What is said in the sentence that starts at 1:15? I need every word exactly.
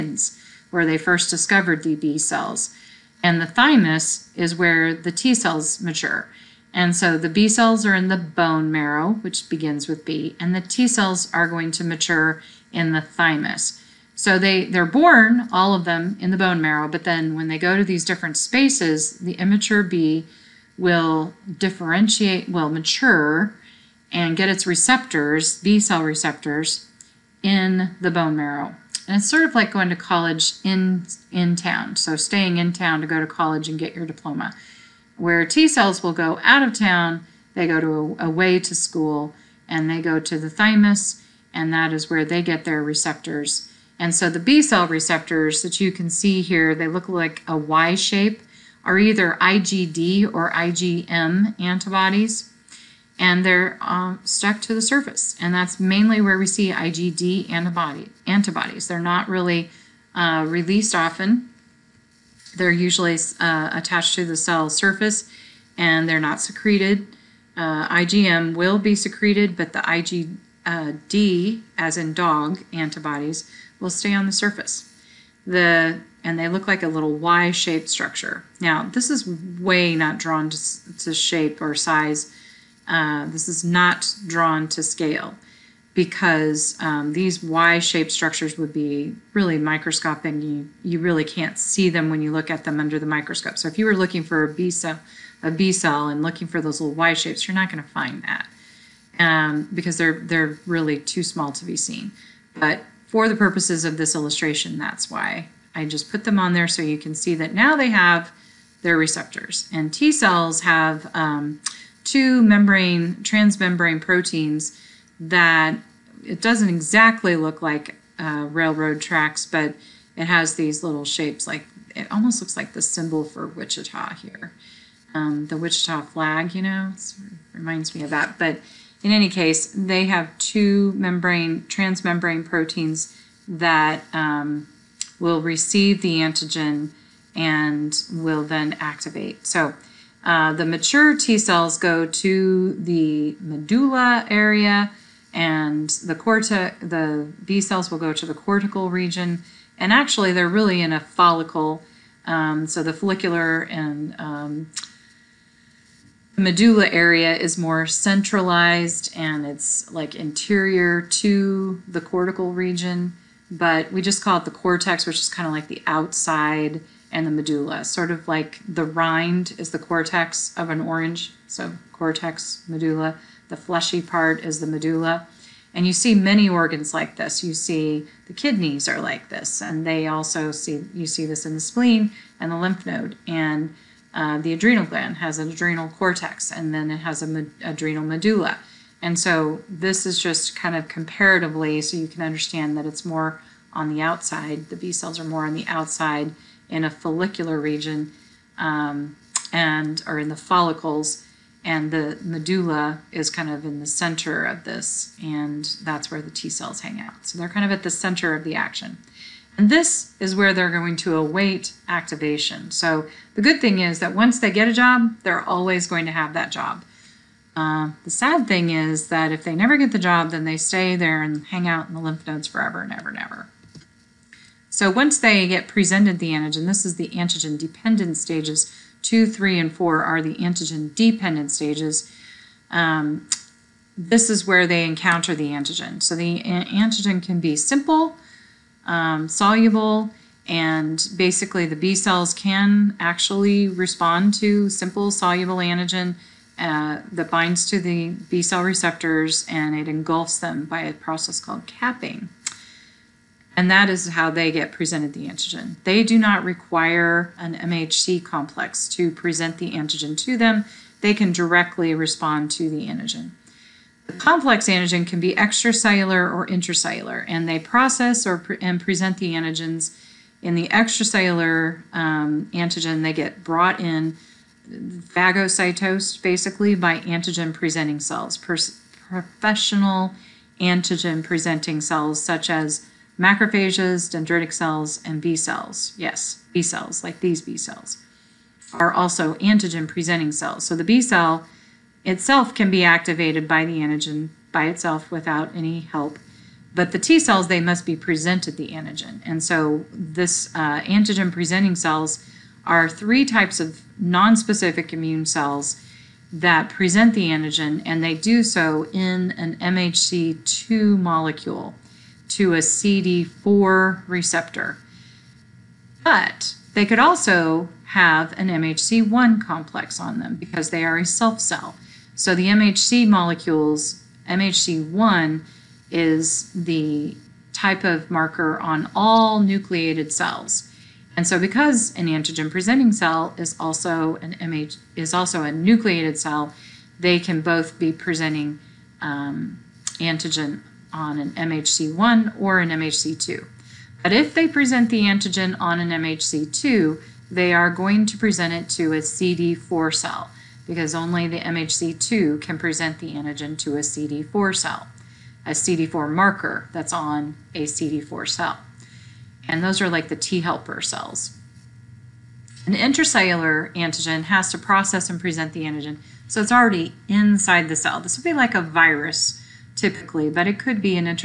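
The and they look like a little Y-shaped structure.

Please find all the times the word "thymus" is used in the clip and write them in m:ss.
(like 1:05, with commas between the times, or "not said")
0:03, 0:13, 0:40.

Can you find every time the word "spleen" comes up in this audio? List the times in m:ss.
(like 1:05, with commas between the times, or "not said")
3:01.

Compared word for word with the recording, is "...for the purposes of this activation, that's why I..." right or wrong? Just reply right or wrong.
wrong.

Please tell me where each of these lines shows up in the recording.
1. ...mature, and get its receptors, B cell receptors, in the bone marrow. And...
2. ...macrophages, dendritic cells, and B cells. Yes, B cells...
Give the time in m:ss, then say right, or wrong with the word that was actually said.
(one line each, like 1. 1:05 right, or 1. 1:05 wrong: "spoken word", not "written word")
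1. 0:22 right
2. 4:43 right.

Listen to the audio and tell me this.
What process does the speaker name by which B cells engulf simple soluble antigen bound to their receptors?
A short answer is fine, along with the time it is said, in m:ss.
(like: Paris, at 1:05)
Capping, at 4:11.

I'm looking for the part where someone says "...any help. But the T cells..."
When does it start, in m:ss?
4:55.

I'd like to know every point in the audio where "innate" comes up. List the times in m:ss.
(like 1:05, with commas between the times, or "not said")
not said.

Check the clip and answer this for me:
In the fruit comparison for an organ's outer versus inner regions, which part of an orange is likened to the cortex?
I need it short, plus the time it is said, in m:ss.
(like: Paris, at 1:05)
The rind, at 2:48.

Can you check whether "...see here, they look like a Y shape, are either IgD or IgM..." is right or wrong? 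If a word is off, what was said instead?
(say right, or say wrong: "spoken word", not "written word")
right.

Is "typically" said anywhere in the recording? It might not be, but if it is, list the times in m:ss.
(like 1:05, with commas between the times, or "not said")
6:09.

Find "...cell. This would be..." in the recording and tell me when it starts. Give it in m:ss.
6:07.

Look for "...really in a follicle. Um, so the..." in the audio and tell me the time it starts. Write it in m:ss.
2:30.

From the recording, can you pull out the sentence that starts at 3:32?
So the good thing is that once they get a job, they're always going to have that job.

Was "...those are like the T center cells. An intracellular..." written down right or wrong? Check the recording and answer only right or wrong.
wrong.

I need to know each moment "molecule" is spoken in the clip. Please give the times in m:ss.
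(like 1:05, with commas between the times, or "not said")
5:10, 5:23.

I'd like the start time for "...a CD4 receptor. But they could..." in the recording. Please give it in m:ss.
5:12.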